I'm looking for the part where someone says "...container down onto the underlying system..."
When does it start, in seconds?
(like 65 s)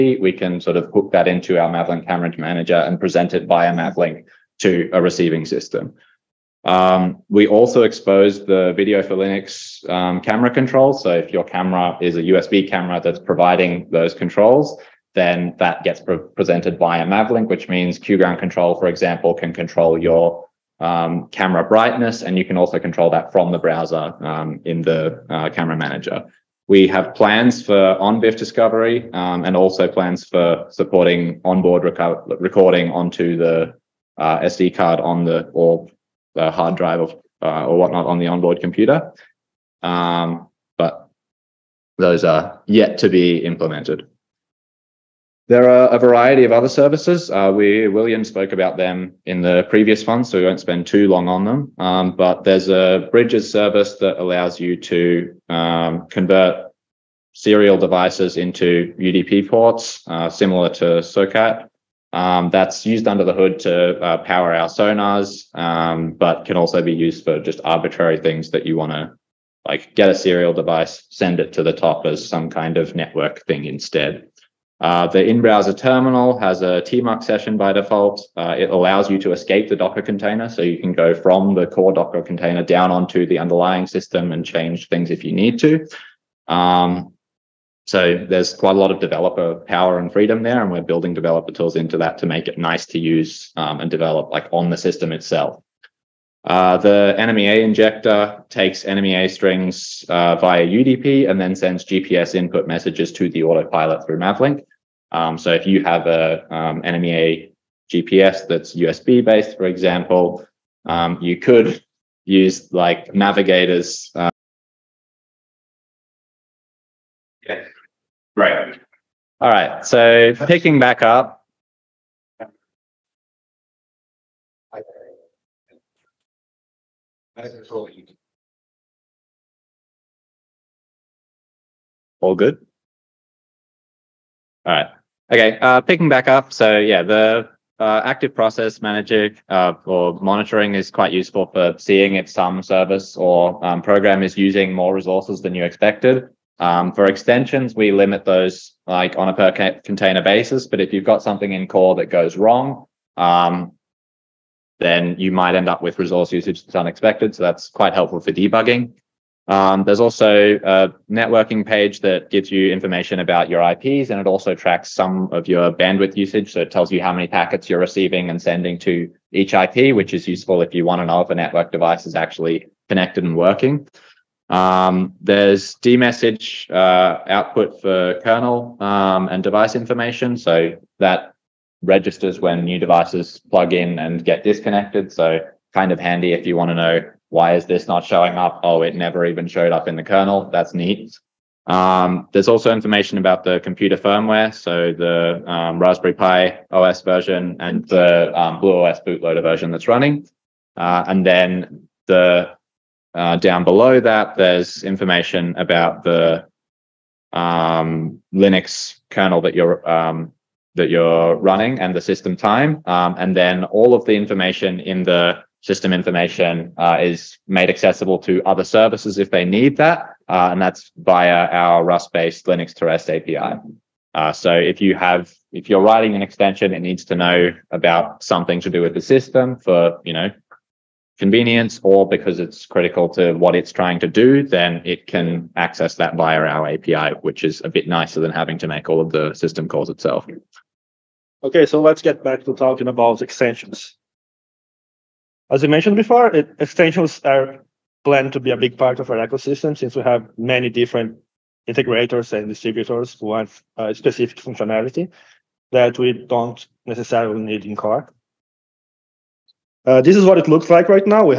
82 s.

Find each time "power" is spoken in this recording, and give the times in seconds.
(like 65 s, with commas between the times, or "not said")
64 s, 89 s.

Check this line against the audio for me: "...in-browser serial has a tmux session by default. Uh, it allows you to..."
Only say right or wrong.
wrong.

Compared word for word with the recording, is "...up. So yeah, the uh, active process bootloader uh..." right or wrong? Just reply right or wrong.
wrong.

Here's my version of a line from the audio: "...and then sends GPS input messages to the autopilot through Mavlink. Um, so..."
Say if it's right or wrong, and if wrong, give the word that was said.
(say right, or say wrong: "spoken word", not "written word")
right.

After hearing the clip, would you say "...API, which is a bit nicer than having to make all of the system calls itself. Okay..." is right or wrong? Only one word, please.
right.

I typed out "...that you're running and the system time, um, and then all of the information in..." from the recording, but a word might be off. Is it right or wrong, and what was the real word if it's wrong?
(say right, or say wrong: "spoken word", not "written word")
right.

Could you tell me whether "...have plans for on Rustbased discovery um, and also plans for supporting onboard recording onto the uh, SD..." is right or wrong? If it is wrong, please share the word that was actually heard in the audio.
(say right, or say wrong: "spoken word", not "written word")
wrong: "ONVIF", not "Rustbased".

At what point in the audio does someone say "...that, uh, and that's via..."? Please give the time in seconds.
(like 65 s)
219 s.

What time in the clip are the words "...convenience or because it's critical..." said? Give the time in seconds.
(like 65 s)
231 s.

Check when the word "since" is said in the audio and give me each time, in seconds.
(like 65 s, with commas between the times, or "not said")
249 s.